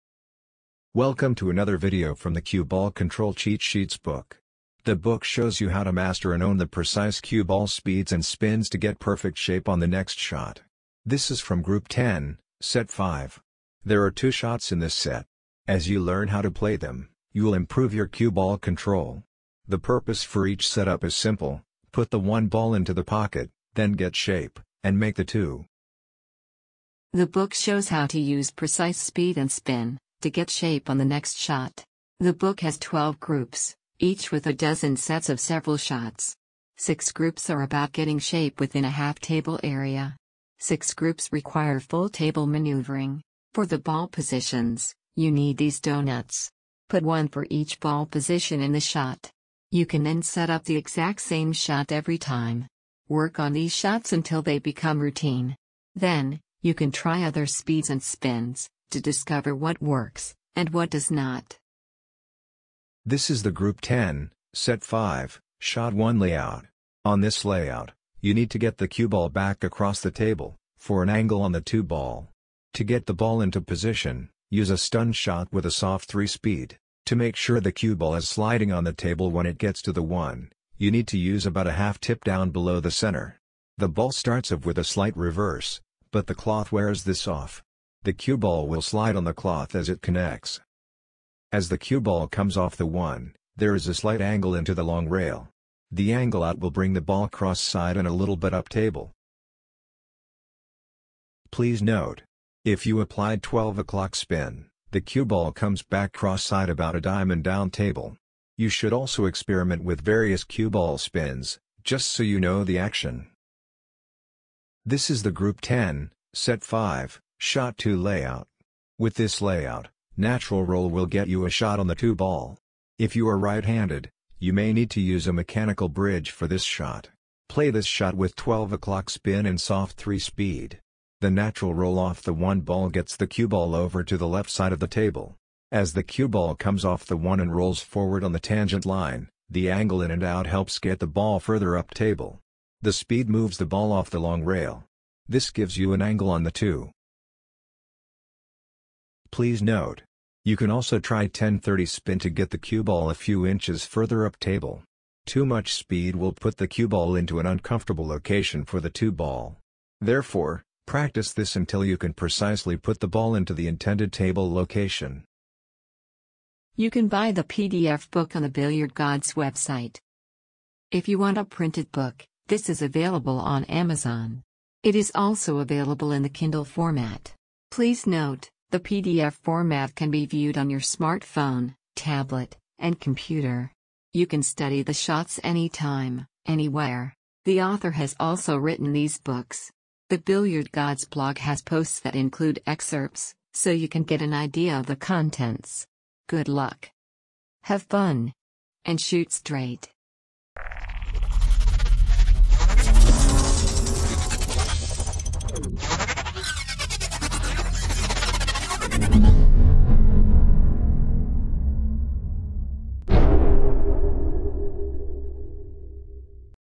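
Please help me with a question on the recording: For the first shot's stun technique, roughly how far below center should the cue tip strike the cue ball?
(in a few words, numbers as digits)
half tip.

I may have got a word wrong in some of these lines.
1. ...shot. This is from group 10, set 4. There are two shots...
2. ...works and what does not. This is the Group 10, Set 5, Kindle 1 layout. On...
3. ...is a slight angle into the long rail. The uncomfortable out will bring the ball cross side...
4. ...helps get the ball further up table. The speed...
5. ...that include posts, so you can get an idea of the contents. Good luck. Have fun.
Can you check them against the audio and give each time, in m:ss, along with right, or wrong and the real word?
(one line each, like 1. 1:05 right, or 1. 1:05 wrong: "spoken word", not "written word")
1. 0:10 wrong: "5", not "4"
2. 0:59 wrong: "Shot", not "Kindle"
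3. 1:33 wrong: "angle", not "uncomfortable"
4. 2:20 right
5. 3:11 wrong: "excerpts", not "posts".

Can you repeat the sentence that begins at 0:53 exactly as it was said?
Work on these shots until they become routine.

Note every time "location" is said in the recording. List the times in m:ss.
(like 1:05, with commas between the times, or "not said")
2:38, 2:44.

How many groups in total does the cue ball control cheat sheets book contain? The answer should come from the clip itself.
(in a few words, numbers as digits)
12.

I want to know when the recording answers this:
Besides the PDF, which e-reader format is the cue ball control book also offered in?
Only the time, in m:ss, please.
2:56.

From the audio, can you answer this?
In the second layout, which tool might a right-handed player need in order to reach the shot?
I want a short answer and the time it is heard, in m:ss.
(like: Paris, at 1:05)
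mechanical bridge, at 2:05.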